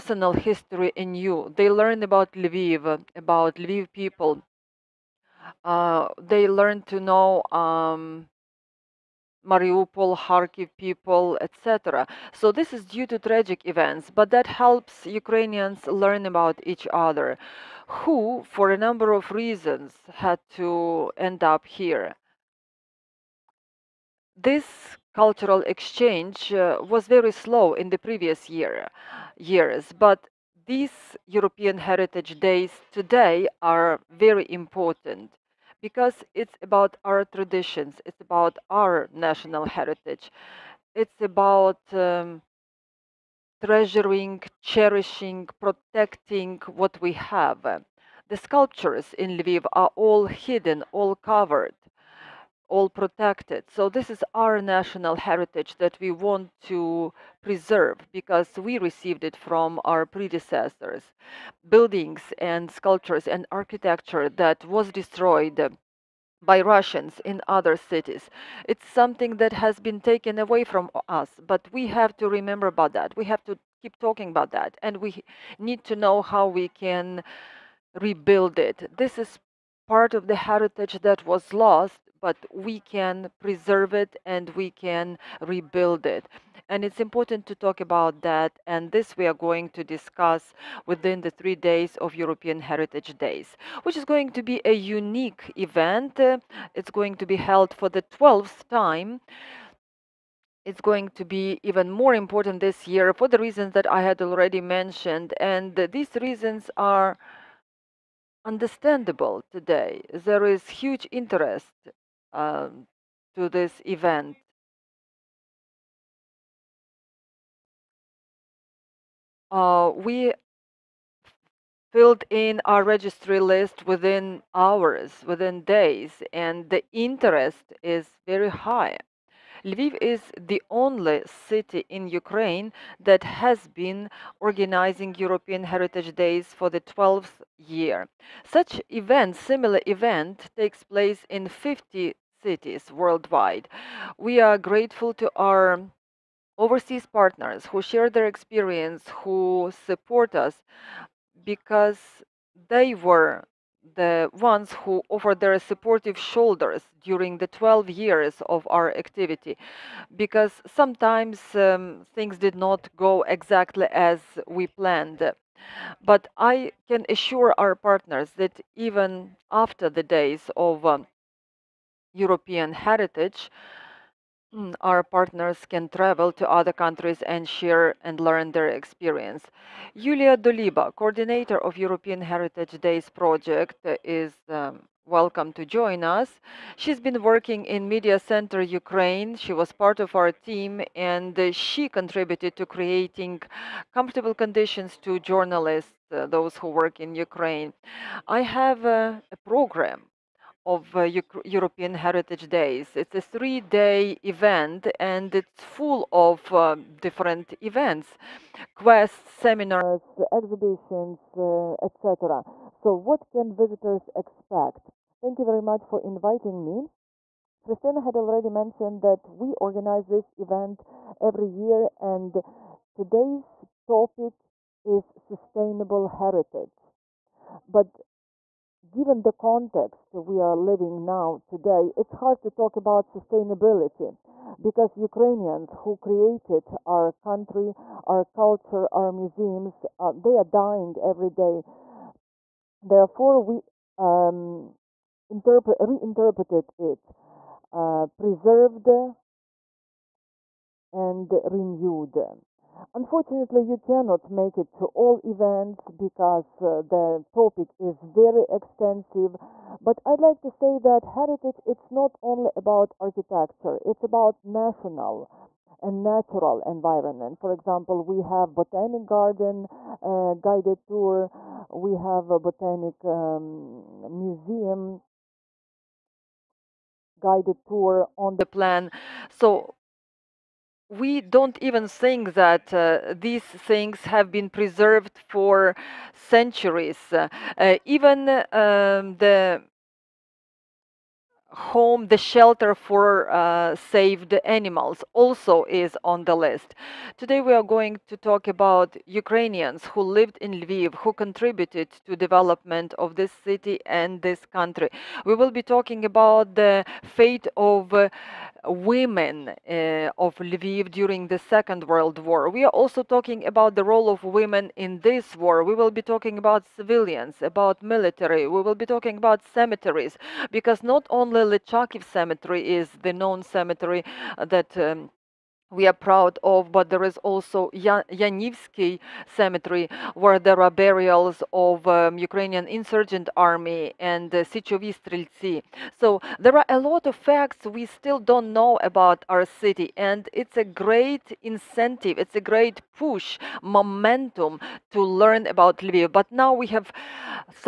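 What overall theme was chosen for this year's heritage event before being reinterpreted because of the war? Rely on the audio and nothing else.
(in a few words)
Sustainable heritage.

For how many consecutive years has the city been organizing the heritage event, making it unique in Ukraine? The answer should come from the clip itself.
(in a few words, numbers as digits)
12.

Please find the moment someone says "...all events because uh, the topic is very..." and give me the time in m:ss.
4:14.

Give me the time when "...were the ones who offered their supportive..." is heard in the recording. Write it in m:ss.
2:33.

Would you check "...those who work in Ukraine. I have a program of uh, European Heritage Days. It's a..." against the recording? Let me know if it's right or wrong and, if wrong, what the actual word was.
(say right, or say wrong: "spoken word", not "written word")
right.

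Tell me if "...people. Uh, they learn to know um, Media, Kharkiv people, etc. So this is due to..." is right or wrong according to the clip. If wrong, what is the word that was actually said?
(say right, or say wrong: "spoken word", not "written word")
wrong: "Mariupol", not "Media".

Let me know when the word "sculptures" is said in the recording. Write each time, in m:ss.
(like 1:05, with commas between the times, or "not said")
0:48, 1:02.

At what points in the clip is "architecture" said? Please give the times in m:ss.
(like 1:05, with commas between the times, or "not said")
1:03, 4:22.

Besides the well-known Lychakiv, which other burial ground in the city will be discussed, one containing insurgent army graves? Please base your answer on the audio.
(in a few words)
Yanivsky Cemetery.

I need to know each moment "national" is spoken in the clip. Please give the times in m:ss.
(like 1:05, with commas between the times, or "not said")
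0:39, 0:54, 4:24.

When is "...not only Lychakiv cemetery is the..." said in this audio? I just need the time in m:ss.
5:20.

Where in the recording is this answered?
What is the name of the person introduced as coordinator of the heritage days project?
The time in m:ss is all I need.
2:59.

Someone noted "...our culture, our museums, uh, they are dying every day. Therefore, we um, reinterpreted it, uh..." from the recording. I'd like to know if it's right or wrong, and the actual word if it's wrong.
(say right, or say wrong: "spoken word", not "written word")
right.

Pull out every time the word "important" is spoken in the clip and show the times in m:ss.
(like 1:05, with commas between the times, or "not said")
0:34, 1:27, 1:42.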